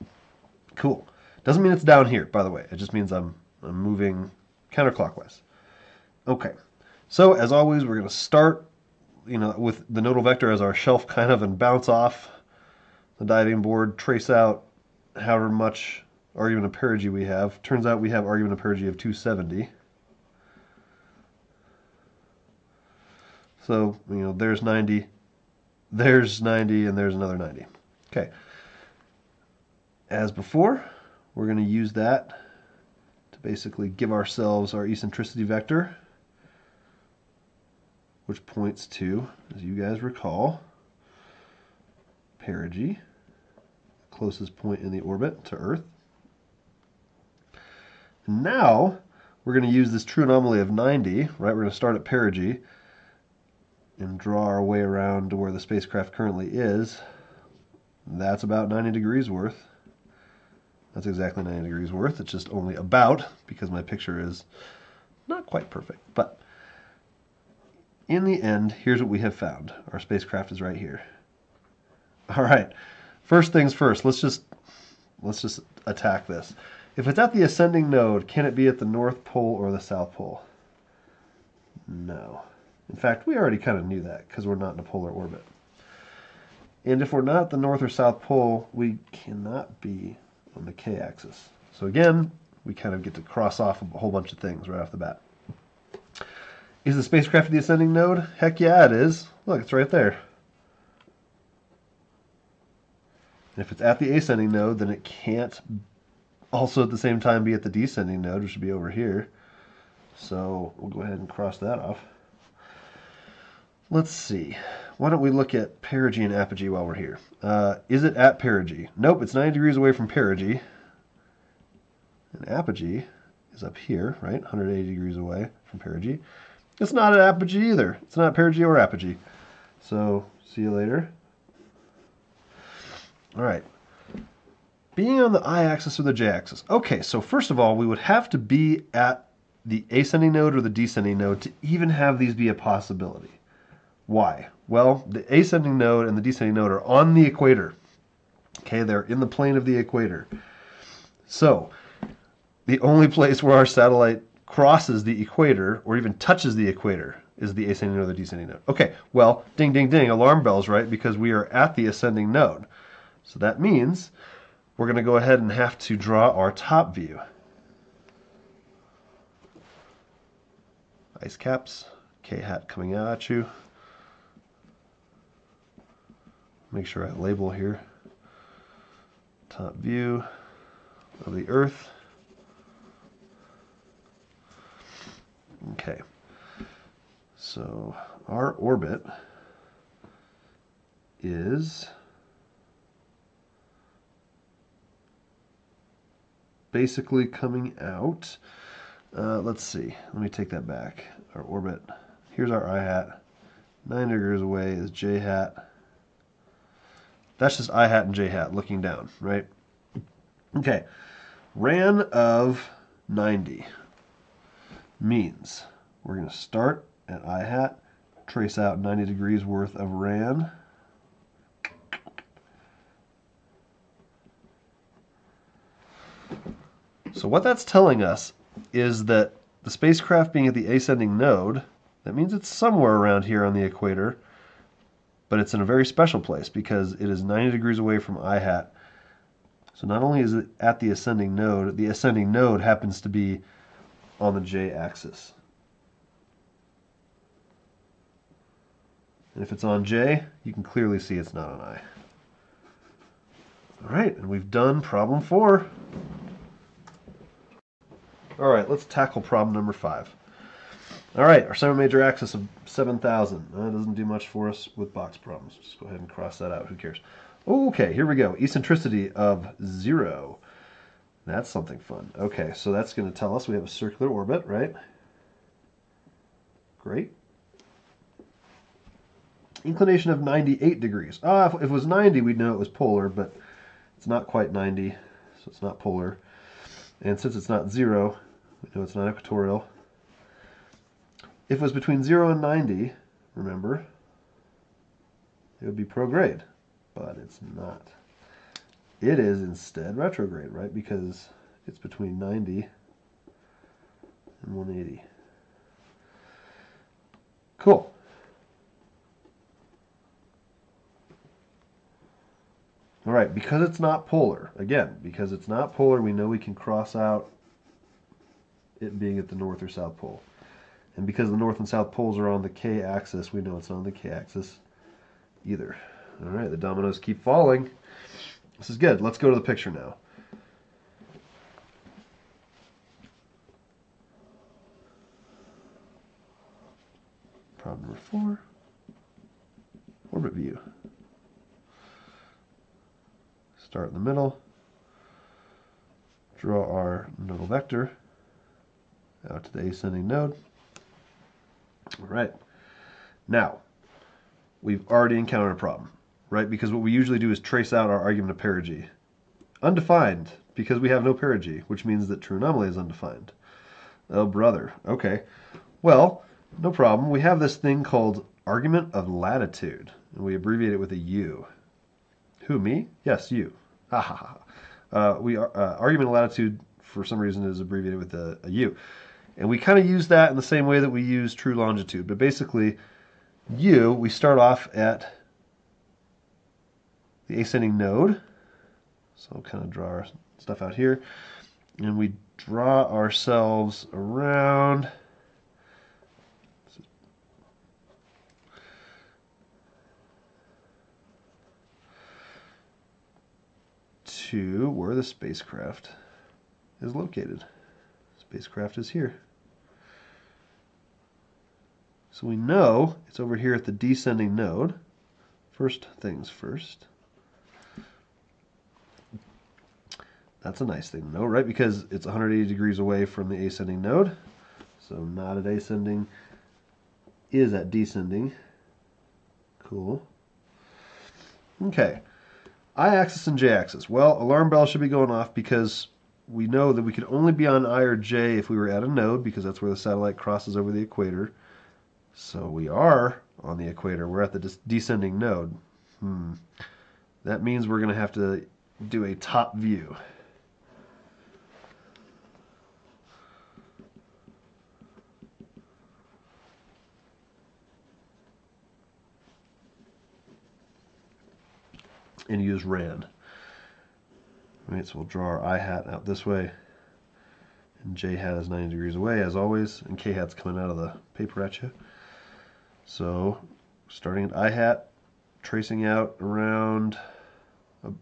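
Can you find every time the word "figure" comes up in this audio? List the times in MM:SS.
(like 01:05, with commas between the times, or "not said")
not said.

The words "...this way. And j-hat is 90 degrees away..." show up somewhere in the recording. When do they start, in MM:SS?
07:46.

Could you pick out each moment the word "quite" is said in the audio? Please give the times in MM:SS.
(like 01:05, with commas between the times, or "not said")
01:05, 04:44.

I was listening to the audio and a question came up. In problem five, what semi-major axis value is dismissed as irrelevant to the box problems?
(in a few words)
7,000.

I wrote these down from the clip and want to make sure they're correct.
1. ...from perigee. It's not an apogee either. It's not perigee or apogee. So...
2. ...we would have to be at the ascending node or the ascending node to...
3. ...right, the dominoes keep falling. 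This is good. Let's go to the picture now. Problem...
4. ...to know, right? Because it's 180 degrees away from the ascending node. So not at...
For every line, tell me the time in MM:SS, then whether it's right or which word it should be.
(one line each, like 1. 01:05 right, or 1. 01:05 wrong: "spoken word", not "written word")
1. 02:05 right
2. 02:17 wrong: "descending", not "ascending"
3. 05:26 right
4. 07:01 right.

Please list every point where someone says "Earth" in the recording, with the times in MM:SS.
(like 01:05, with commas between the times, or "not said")
00:45, 03:01.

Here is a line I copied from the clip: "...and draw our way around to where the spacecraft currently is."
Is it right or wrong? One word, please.
right.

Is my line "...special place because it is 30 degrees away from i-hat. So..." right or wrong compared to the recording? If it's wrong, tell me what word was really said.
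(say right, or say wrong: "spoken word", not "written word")
wrong: "90", not "30".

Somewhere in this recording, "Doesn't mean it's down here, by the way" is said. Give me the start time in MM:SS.
00:01.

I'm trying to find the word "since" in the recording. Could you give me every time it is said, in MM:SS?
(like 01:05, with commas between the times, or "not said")
04:47.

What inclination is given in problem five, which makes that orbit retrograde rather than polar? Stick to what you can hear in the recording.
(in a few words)
98 degrees.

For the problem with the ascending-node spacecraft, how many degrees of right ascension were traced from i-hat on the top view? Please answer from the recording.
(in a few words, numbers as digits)
90.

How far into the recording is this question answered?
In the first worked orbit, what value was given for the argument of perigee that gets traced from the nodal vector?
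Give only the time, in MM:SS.
00:18.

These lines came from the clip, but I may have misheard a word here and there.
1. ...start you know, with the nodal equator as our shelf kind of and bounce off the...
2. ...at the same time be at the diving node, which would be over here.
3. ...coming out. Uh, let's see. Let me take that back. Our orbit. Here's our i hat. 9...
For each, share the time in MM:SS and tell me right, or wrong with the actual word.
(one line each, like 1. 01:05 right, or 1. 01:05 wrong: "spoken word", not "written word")
1. 00:08 wrong: "vector", not "equator"
2. 01:46 wrong: "descending", not "diving"
3. 03:17 right.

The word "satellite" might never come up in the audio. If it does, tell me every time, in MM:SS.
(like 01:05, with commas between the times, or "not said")
02:33, 07:19.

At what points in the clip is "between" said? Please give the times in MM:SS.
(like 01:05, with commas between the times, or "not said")
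04:51, 05:01.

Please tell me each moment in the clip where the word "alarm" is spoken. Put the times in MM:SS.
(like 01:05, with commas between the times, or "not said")
02:40, 07:14.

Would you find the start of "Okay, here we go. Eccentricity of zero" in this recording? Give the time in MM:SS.
04:27.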